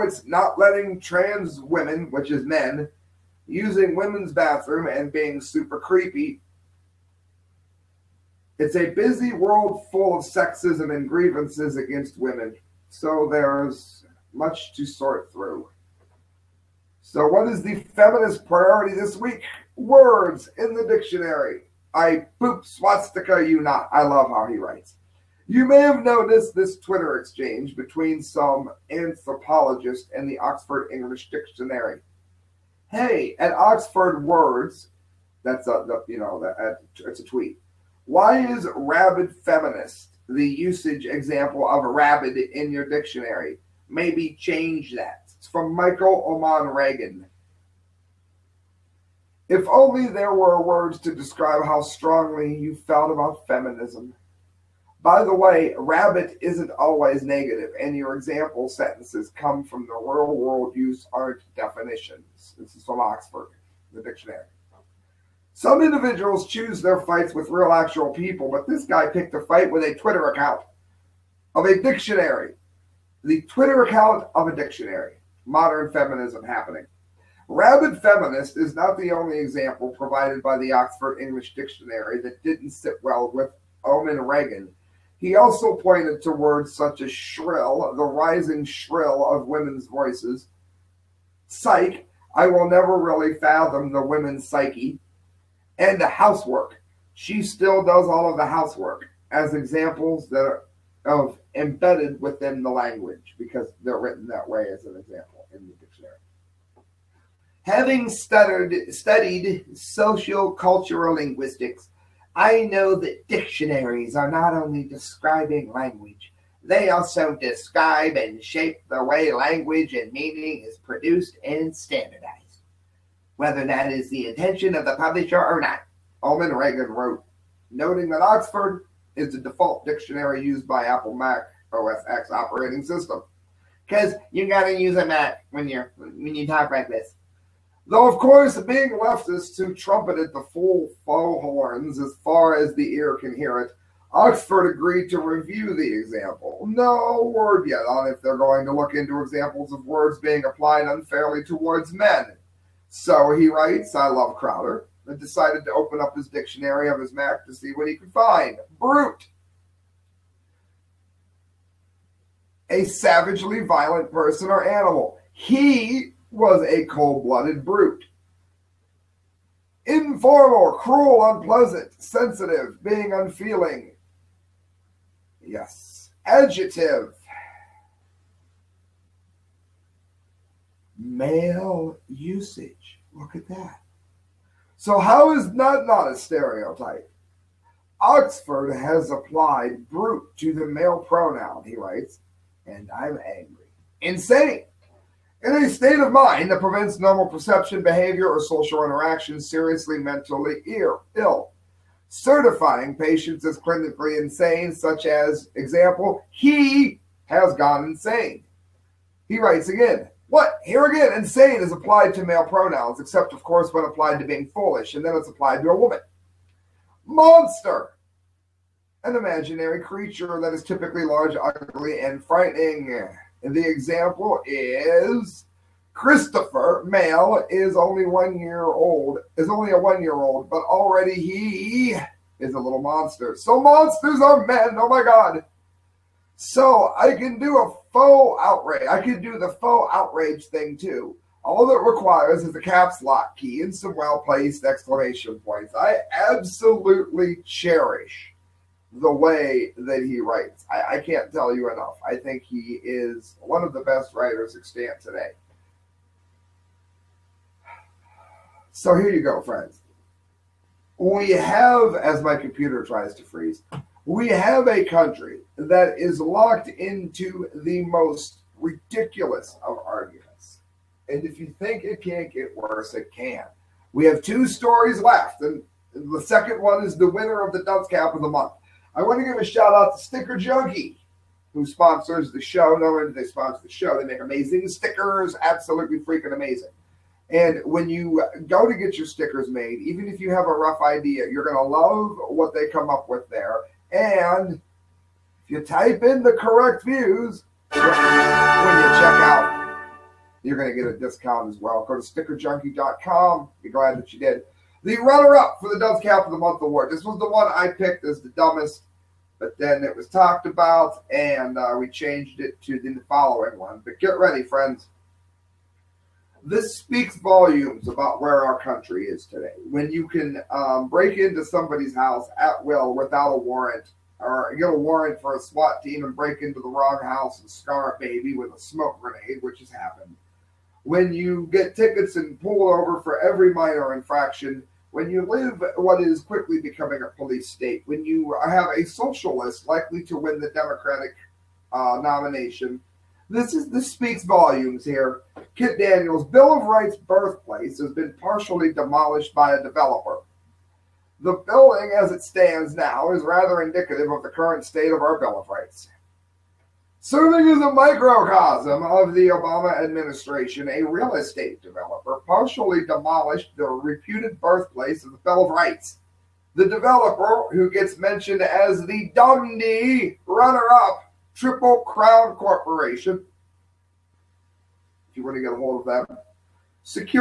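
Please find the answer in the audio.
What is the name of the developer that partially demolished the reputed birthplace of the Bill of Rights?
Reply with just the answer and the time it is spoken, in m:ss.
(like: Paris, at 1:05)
Triple Crown Corporation, at 6:11.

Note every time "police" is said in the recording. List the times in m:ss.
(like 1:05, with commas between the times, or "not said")
5:37.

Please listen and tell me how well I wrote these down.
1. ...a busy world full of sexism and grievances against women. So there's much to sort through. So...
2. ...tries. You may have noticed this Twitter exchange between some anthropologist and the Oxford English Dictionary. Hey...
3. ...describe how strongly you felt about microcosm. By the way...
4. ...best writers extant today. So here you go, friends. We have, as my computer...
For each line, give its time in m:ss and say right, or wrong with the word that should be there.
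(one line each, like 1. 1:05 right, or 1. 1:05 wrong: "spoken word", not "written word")
1. 0:08 right
2. 0:24 wrong: "writes", not "tries"
3. 0:51 wrong: "feminism", not "microcosm"
4. 4:13 right.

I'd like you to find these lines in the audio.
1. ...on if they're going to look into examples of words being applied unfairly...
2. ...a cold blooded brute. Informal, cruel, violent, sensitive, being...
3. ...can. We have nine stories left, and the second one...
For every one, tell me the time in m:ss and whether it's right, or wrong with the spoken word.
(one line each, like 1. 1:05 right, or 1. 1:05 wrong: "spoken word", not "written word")
1. 2:27 right
2. 2:46 wrong: "unpleasant", not "violent"
3. 4:33 wrong: "two", not "nine".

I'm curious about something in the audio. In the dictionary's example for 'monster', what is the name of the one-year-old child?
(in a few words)
Christopher.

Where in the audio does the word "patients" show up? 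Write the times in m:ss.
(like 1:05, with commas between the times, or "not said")
3:22.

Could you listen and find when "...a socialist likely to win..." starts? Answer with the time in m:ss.
5:38.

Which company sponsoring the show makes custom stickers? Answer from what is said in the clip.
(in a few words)
Sticker Junkie.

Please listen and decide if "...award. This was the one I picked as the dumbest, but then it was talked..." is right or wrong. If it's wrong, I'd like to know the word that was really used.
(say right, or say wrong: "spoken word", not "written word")
right.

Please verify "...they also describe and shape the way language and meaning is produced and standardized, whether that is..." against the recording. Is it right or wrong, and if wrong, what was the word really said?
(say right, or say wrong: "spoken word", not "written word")
right.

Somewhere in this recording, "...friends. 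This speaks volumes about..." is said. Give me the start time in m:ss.
5:14.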